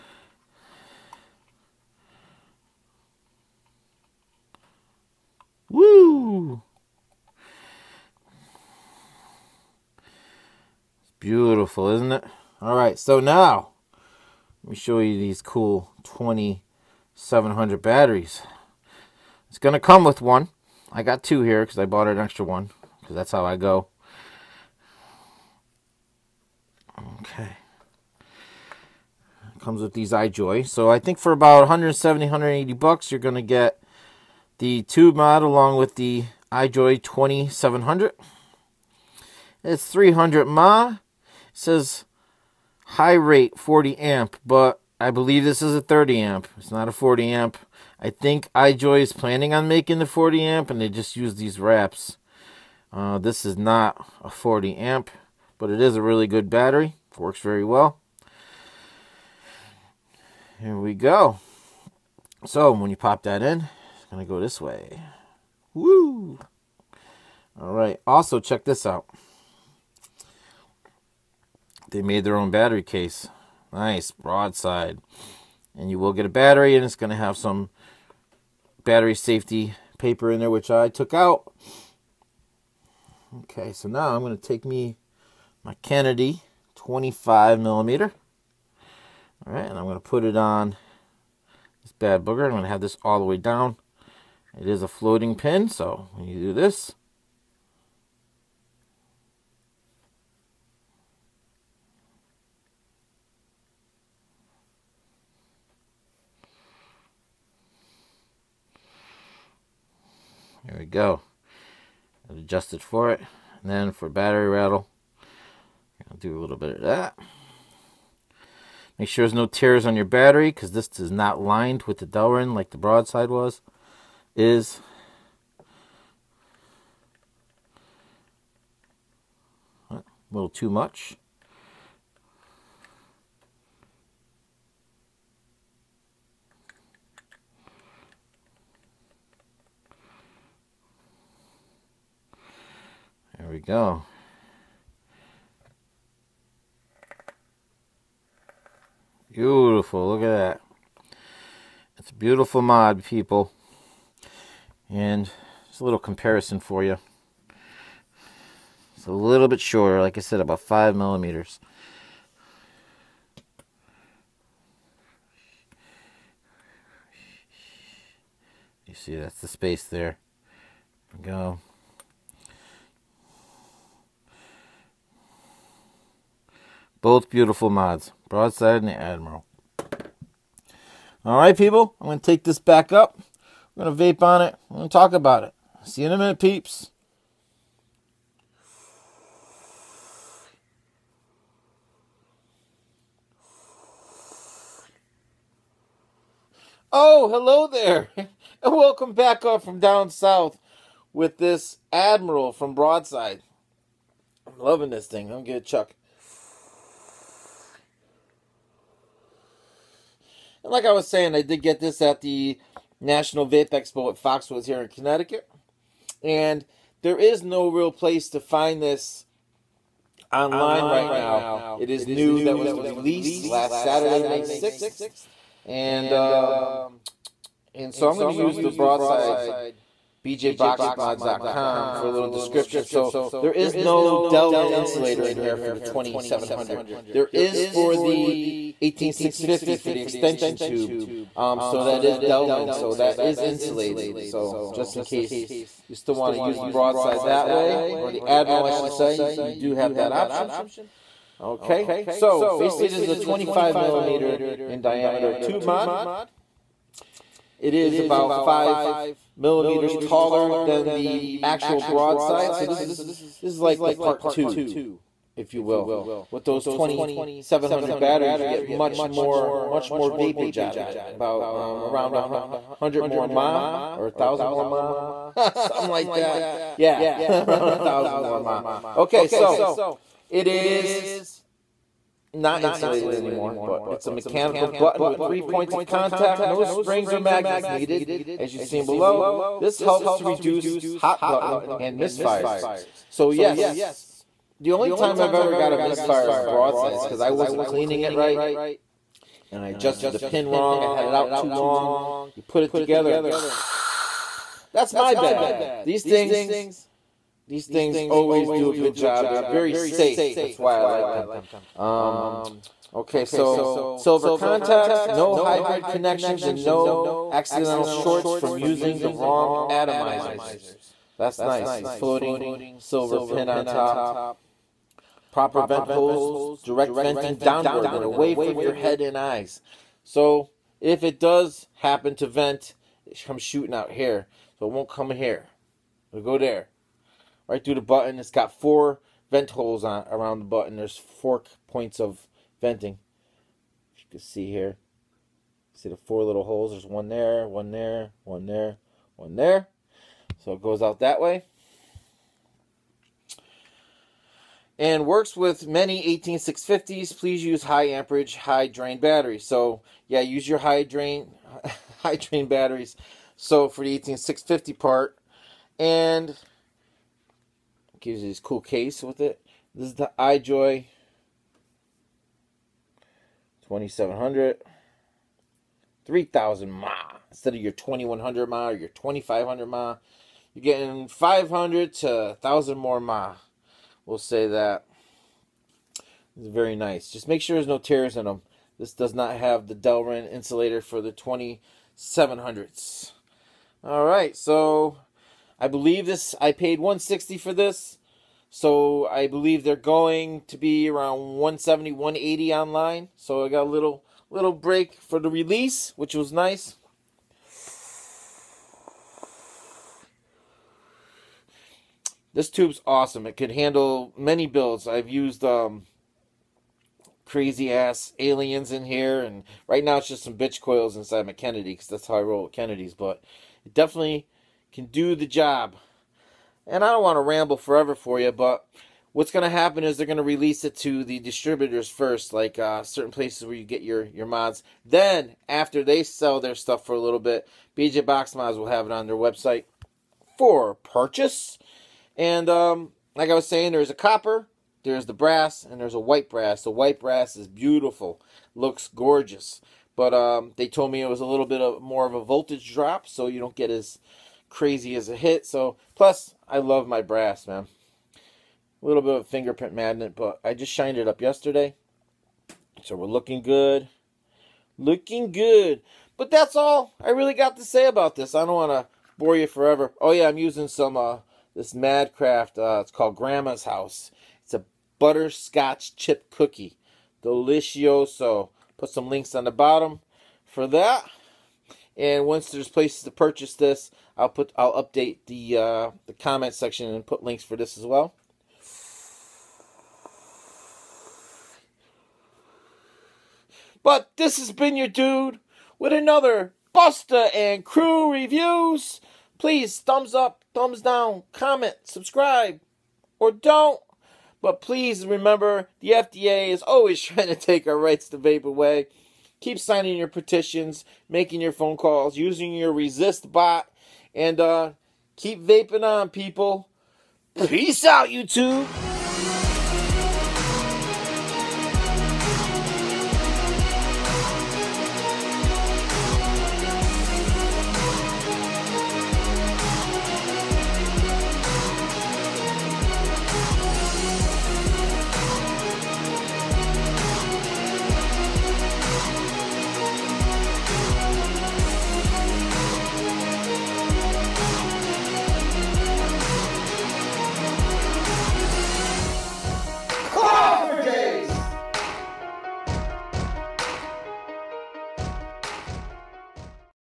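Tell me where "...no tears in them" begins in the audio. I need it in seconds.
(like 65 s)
387 s.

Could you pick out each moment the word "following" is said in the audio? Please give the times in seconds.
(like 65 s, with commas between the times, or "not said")
not said.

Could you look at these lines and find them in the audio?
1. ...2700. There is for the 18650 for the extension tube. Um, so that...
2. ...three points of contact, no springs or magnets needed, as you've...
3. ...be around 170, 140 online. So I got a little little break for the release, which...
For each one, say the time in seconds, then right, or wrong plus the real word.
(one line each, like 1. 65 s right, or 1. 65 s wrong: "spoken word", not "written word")
1. 235 s right
2. 285 s right
3. 400 s wrong: "180", not "140".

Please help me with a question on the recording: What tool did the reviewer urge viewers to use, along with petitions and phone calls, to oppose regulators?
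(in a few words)
Resist Bot.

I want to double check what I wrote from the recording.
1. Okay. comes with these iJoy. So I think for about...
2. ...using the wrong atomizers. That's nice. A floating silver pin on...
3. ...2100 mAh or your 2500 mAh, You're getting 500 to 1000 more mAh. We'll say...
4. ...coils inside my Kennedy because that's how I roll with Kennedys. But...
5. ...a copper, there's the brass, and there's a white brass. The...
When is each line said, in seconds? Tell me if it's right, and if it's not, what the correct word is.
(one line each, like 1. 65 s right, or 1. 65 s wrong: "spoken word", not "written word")
1. 27 s right
2. 318 s right
3. 377 s right
4. 420 s right
5. 443 s right.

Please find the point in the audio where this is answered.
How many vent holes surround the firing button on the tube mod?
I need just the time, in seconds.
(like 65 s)
338 s.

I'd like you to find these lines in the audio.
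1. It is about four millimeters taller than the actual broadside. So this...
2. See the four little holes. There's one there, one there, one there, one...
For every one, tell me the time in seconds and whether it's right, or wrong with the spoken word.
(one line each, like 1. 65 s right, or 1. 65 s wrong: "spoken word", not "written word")
1. 257 s wrong: "five", not "four"
2. 345 s right.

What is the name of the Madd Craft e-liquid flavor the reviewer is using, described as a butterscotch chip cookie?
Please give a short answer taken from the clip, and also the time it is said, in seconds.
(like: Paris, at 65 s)
Grandma's House, at 473 s.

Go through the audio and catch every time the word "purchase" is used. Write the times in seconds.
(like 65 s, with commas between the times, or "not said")
440 s, 483 s.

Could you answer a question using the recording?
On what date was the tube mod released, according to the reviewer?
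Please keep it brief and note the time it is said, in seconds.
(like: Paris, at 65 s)
May 6th, at 224 s.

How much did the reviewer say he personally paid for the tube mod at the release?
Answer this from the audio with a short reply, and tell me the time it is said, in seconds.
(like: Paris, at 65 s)
160, at 396 s.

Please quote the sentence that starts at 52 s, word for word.
Uh, this is not a 40 amp, but it is a really good battery.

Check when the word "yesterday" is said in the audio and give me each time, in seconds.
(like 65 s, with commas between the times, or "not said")
461 s.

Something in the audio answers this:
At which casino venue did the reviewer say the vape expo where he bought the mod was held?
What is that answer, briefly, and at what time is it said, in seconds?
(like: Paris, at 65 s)
Foxwoods, at 214 s.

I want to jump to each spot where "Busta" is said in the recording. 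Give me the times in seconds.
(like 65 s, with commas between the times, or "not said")
496 s.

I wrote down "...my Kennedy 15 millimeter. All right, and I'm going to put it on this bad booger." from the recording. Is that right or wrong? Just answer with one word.
wrong.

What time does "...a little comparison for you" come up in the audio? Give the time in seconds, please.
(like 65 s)
155 s.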